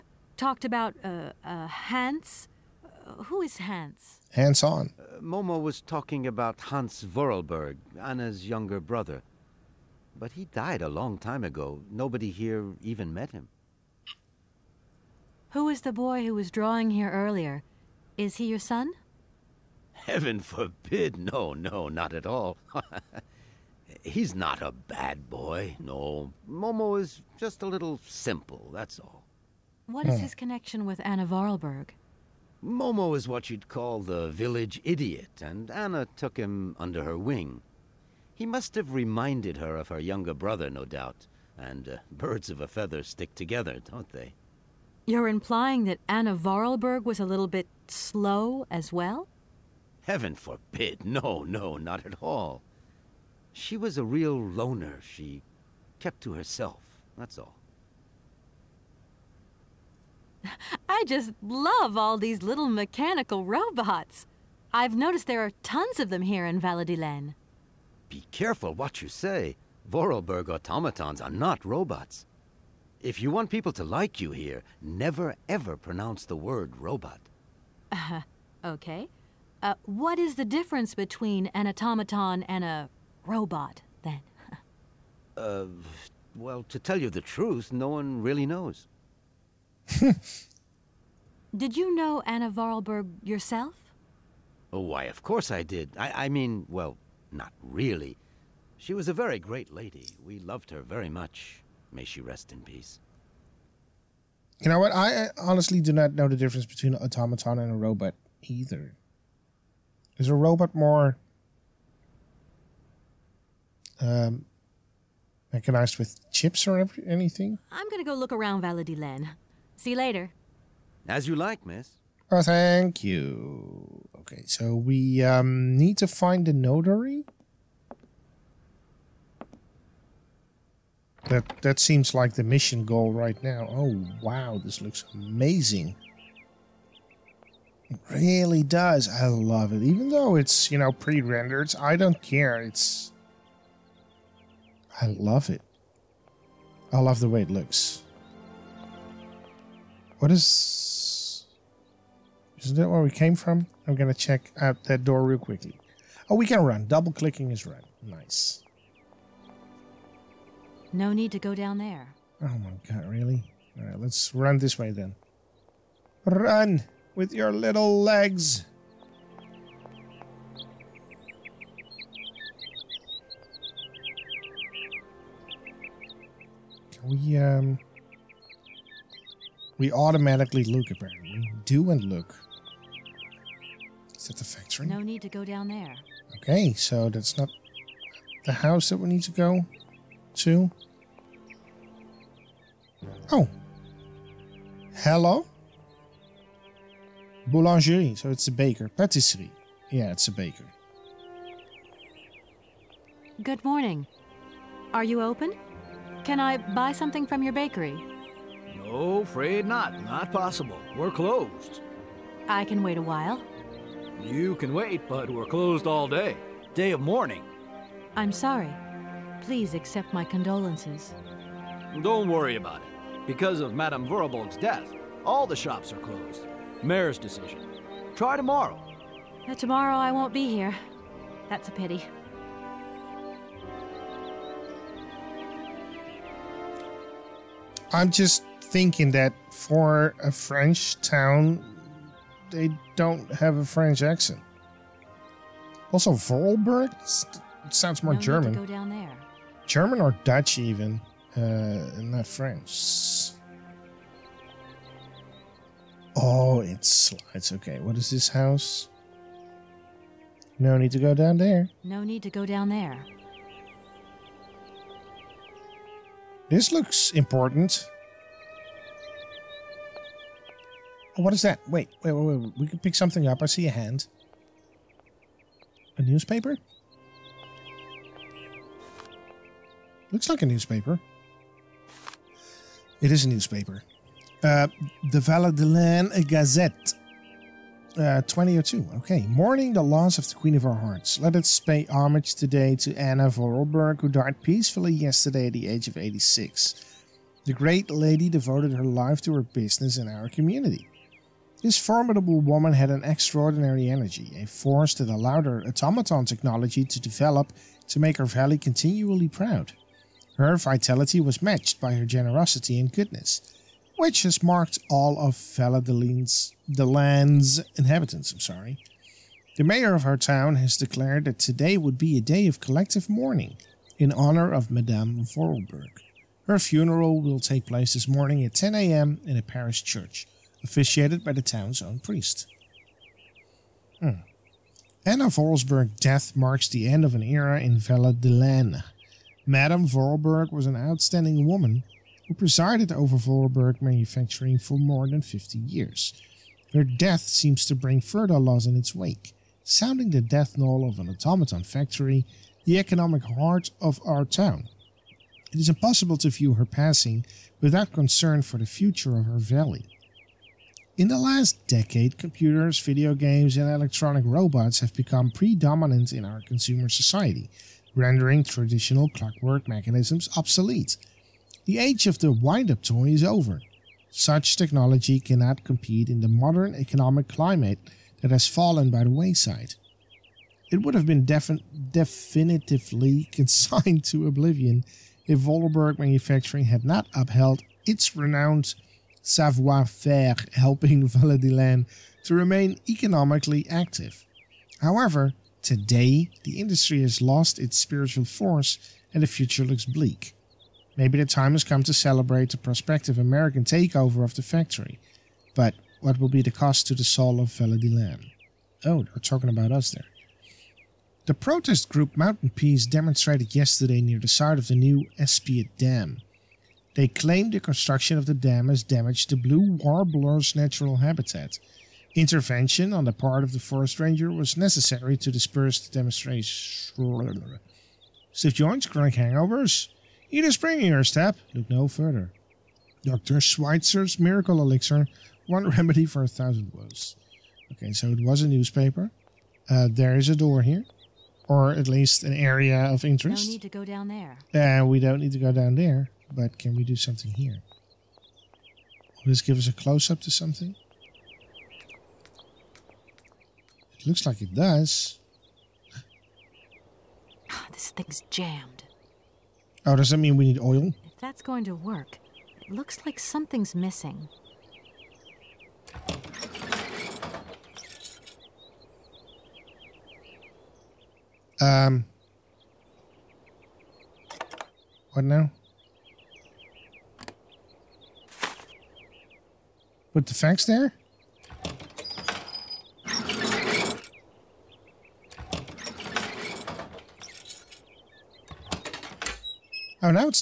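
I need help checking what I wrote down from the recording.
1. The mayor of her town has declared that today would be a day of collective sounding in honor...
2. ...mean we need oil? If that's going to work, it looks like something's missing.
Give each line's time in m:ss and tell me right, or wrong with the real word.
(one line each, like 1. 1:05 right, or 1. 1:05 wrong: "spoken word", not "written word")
1. 5:19 wrong: "mourning", not "sounding"
2. 7:40 right.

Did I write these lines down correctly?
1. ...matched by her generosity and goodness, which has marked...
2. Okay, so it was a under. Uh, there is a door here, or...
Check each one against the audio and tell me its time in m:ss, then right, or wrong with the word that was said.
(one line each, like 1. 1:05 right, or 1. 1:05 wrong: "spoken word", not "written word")
1. 5:11 right
2. 7:17 wrong: "newspaper", not "under".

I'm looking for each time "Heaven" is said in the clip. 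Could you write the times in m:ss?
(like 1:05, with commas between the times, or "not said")
0:19, 0:50.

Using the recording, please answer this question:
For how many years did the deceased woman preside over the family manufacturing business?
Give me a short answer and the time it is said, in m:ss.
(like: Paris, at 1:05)
more than 50, at 5:44.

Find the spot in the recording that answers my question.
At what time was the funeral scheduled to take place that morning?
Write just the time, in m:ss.
5:28.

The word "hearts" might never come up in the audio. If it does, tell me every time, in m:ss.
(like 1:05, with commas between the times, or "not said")
4:50, 5:53.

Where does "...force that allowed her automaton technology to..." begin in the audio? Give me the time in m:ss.
5:04.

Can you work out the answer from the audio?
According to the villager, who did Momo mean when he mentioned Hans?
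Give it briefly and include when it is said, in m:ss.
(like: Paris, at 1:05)
Anna's younger brother, at 0:07.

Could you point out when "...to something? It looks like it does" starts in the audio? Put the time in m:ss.
7:30.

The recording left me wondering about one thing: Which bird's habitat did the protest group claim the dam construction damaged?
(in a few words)
blue warbler.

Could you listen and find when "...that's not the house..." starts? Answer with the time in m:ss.
3:07.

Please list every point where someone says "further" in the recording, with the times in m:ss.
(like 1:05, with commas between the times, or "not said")
5:47, 7:11.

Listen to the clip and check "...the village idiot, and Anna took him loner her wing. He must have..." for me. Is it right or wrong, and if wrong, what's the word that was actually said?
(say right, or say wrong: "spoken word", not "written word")
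wrong: "under", not "loner".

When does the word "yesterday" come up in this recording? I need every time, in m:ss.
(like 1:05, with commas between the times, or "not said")
4:54, 6:53.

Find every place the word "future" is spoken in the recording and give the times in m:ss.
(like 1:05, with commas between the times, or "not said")
5:58, 6:39.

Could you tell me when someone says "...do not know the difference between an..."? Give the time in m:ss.
1:45.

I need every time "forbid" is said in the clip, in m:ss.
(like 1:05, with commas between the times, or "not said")
0:20, 0:50.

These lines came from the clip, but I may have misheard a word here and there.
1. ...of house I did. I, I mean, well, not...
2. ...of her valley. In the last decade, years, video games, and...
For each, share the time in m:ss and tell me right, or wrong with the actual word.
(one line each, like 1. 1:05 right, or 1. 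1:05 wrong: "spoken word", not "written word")
1. 1:35 wrong: "course", not "house"
2. 5:59 wrong: "computers", not "years".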